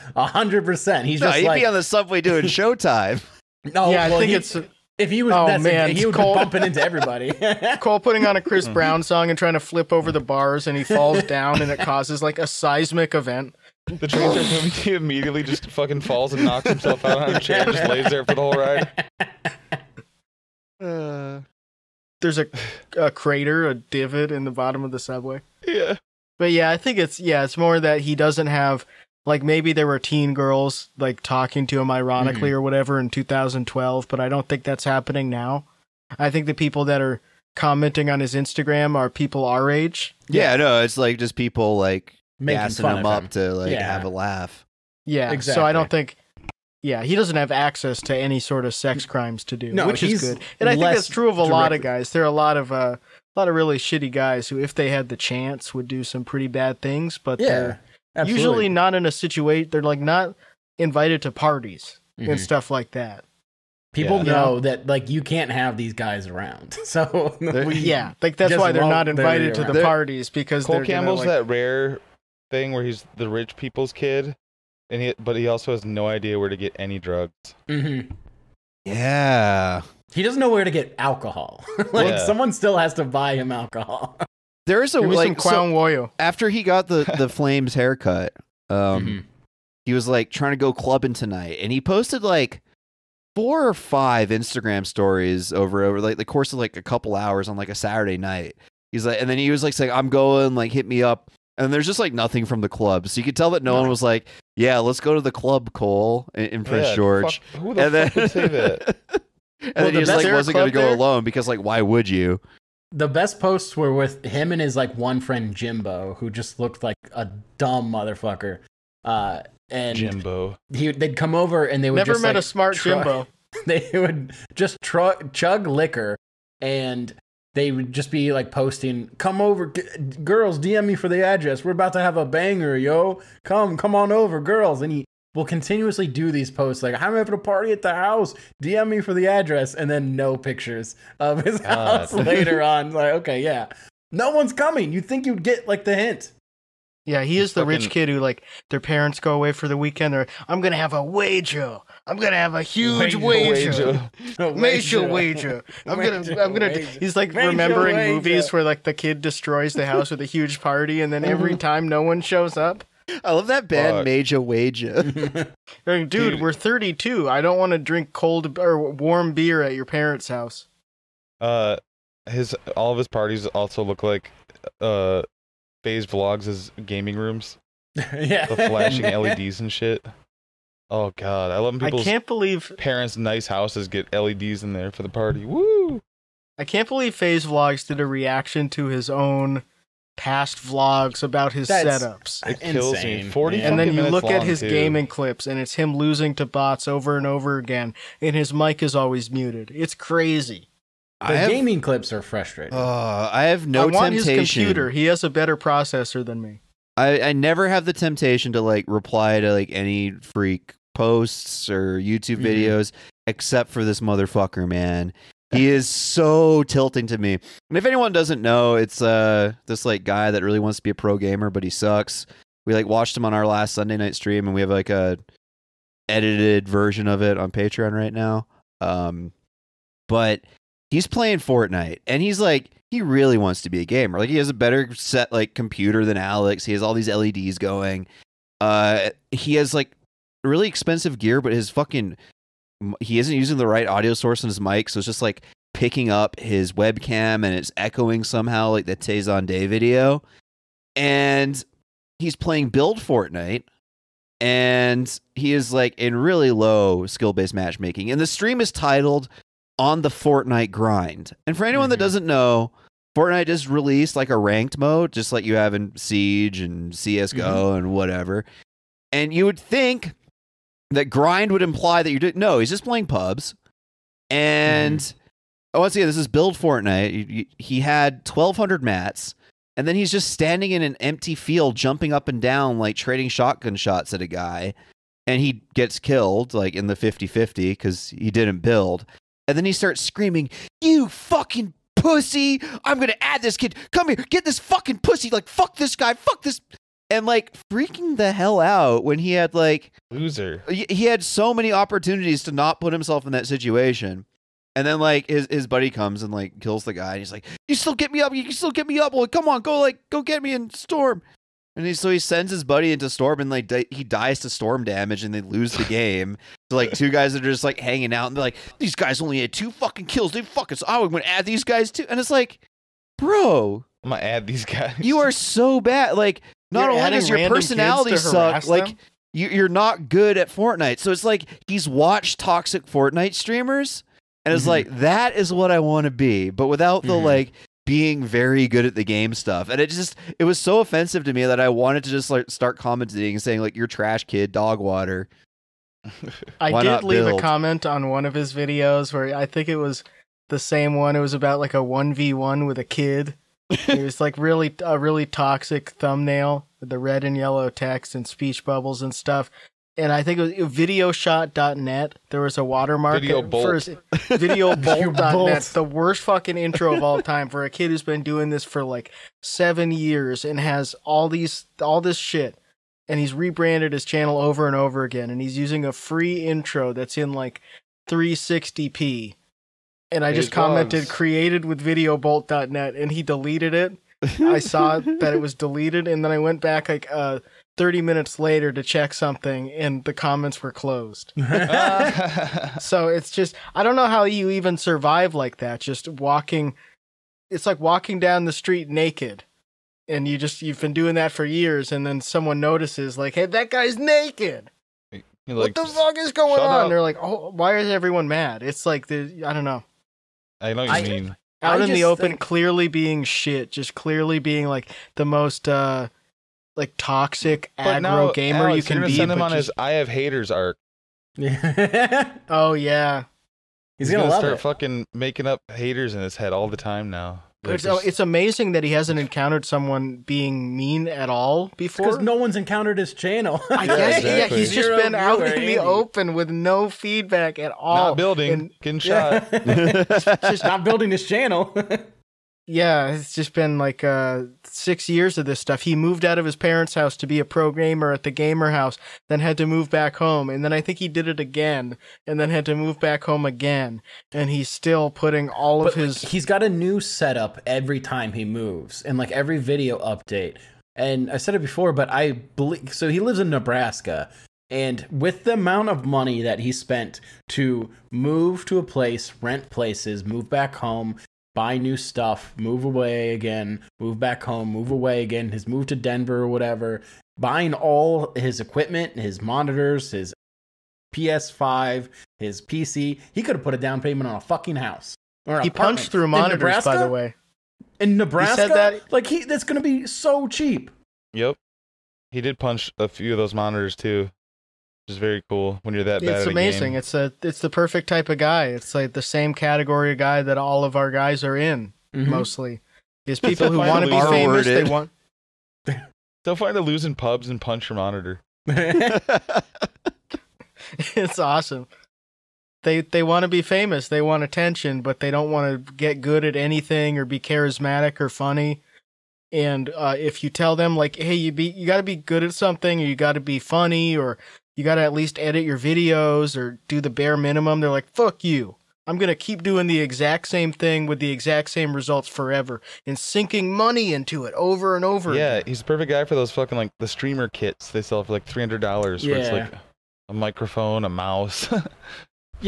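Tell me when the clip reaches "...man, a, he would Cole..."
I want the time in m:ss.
0:05.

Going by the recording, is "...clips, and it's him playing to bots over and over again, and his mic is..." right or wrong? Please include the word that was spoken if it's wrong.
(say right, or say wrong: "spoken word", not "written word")
wrong: "losing", not "playing".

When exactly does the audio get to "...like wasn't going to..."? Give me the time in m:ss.
1:50.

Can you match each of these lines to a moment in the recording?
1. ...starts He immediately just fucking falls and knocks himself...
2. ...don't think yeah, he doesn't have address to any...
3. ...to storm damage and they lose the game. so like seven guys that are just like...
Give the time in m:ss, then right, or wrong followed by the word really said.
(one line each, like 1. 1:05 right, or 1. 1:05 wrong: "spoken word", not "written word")
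1. 0:14 right
2. 0:45 wrong: "access", not "address"
3. 5:14 wrong: "two", not "seven".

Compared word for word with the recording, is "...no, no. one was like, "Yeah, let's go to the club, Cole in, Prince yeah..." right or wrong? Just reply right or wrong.
right.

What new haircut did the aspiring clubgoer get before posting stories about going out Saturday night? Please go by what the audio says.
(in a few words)
flames haircut.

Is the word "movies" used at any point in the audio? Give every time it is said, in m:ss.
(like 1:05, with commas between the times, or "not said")
2:38.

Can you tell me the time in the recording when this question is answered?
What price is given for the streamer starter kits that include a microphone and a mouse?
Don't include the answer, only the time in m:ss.
8:58.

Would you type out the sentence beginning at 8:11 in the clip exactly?
Yep, he did punch a few of those monitors too which is very cool when you're that bad.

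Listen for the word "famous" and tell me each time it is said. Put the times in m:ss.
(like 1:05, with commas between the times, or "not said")
8:24, 8:33.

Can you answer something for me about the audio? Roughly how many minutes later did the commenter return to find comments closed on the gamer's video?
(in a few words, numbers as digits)
30.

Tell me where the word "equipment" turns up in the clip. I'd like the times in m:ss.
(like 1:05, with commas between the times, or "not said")
7:58.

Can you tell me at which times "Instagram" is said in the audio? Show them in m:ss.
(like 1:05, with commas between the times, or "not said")
0:38, 1:34.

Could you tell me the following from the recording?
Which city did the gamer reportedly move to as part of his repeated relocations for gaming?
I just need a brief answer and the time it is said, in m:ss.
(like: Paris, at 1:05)
Denver, at 7:55.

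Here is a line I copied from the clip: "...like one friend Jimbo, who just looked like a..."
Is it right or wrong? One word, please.
right.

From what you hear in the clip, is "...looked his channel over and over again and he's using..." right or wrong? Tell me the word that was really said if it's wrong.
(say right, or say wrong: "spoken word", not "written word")
wrong: "rebranded", not "looked".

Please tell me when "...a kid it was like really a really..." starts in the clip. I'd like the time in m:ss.
5:52.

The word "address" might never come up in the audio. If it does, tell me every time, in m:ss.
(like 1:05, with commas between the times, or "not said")
2:11, 2:19.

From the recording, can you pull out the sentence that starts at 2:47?
I don't want to drink cold or warm beer at your parents' house.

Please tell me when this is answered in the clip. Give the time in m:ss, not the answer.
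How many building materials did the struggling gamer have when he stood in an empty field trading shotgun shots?
4:38.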